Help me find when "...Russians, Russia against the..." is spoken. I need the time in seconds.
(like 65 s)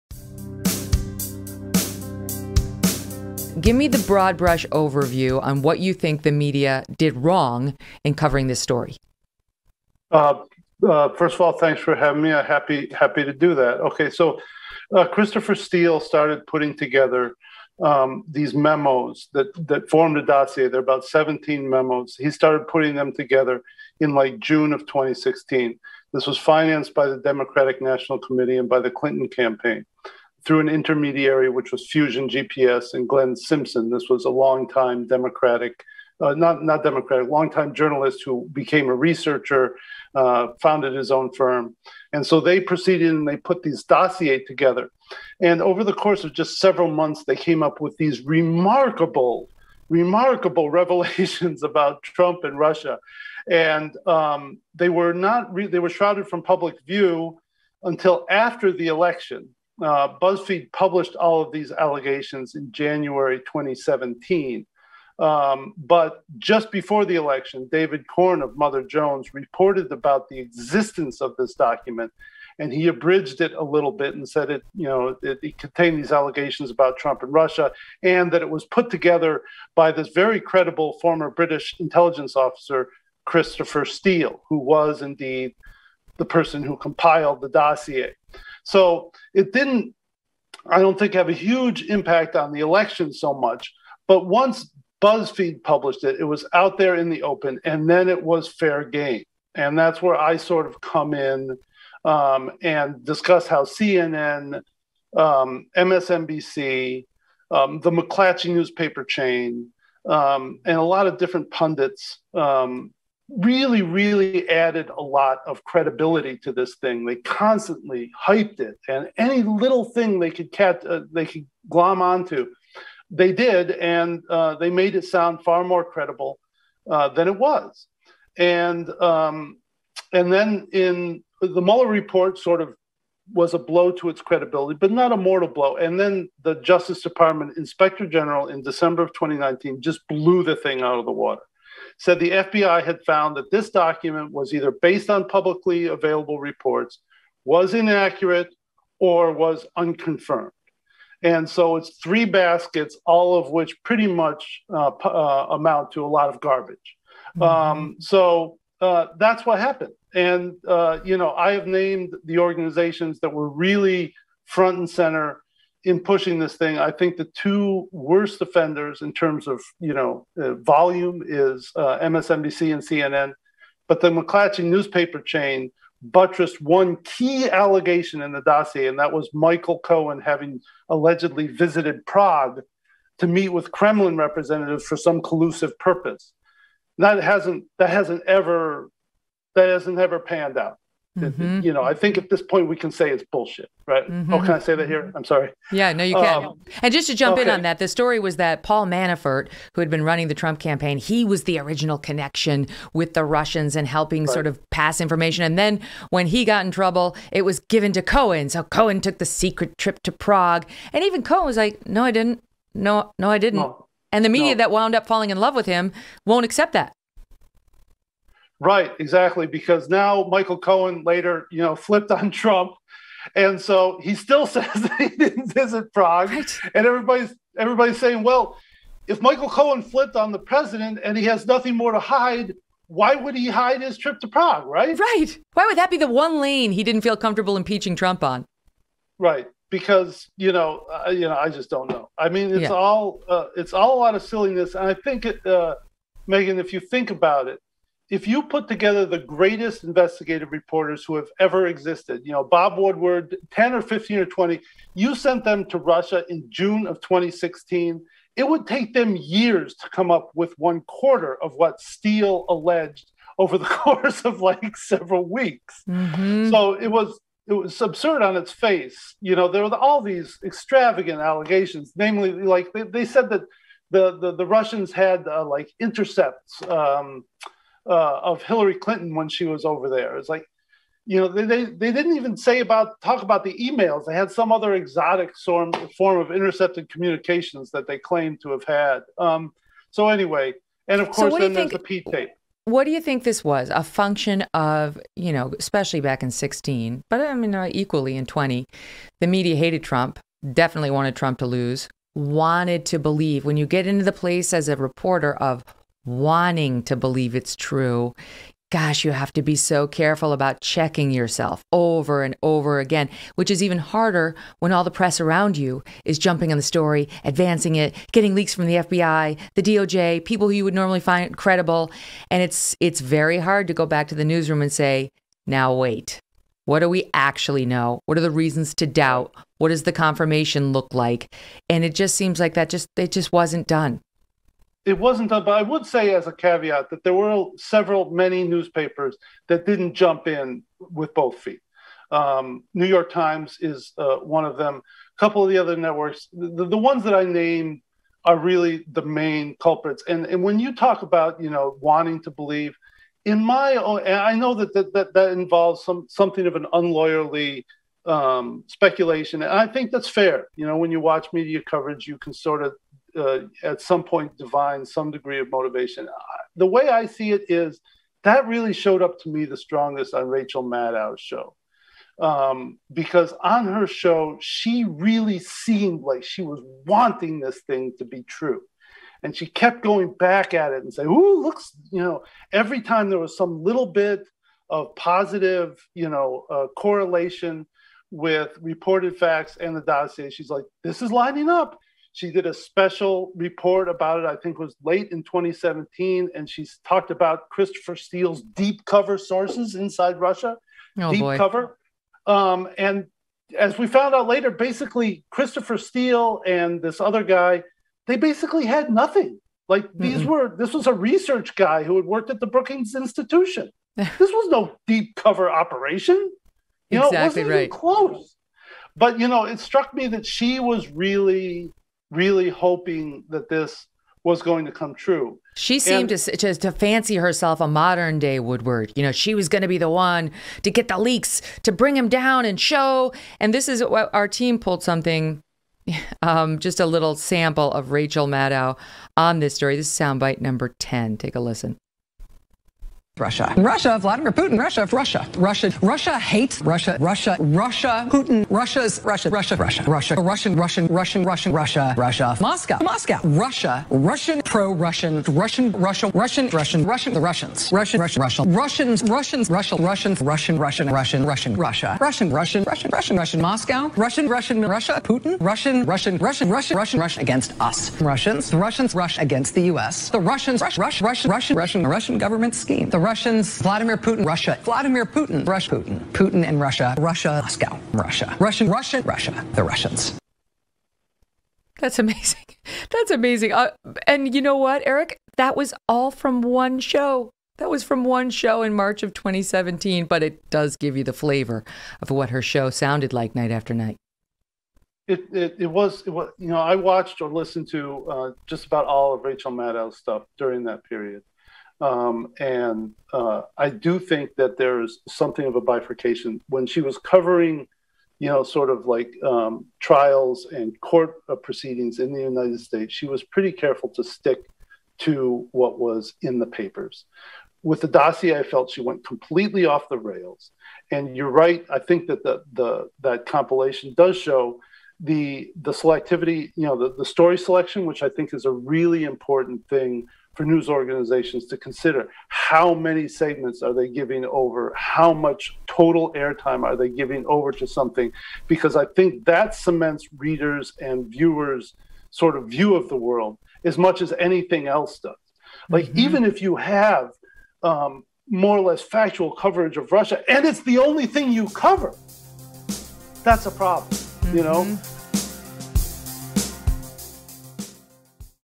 468 s.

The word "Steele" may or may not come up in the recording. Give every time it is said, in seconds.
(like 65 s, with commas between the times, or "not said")
15 s, 83 s, 261 s, 397 s, 405 s.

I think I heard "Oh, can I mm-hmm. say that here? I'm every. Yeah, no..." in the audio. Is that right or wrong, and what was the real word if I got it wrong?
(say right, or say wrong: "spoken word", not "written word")
wrong: "sorry", not "every".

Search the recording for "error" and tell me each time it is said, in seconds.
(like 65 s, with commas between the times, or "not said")
not said.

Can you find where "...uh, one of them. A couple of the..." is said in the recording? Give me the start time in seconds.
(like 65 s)
343 s.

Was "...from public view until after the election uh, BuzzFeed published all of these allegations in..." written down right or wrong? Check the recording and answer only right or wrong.
right.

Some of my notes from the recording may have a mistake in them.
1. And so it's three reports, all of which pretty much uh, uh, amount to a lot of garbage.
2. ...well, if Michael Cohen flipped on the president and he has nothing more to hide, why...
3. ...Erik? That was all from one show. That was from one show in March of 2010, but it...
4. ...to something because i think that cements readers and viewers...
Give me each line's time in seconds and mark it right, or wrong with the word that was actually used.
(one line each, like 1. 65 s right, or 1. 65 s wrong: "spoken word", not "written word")
1. 151 s wrong: "baskets", not "reports"
2. 228 s right
3. 484 s wrong: "2017", not "2010"
4. 537 s right.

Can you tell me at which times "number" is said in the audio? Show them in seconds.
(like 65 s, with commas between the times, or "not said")
440 s.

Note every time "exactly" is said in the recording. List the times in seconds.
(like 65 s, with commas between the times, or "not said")
218 s, 416 s.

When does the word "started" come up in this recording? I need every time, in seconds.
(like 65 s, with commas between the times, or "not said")
15 s, 22 s.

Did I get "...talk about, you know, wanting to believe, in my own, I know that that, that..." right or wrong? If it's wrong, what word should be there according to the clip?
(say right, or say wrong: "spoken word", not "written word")
right.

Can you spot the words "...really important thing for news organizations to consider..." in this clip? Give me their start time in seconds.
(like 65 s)
528 s.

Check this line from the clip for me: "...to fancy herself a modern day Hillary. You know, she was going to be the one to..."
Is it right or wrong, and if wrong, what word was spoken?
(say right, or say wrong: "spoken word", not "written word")
wrong: "Woodward", not "Hillary".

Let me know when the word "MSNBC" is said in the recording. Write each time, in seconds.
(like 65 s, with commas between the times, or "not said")
105 s, 171 s.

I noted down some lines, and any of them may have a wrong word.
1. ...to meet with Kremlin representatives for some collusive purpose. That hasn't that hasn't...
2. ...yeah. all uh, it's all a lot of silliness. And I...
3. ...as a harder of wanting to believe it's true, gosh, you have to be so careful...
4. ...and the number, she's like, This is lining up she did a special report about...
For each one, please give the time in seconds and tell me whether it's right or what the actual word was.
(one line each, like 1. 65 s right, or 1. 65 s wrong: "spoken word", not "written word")
1. 183 s right
2. 242 s right
3. 304 s wrong: "reporter", not "harder"
4. 389 s wrong: "dossier", not "number".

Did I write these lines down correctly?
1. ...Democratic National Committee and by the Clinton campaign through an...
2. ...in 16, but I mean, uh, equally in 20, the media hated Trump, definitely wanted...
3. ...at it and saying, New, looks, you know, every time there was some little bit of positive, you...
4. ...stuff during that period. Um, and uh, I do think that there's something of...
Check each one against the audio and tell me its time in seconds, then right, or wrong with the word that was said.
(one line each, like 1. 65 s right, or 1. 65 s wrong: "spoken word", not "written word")
1. 27 s right
2. 296 s right
3. 380 s wrong: "Ooh", not "New"
4. 499 s right.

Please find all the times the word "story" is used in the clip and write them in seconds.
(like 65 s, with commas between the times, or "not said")
8 s, 197 s, 316 s, 439 s, 527 s.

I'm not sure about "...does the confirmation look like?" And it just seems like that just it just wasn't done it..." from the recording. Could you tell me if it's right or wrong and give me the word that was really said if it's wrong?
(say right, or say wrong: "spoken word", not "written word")
right.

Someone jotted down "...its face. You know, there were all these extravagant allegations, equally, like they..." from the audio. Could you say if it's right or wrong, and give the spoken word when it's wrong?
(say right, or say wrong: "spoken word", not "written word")
wrong: "namely", not "equally".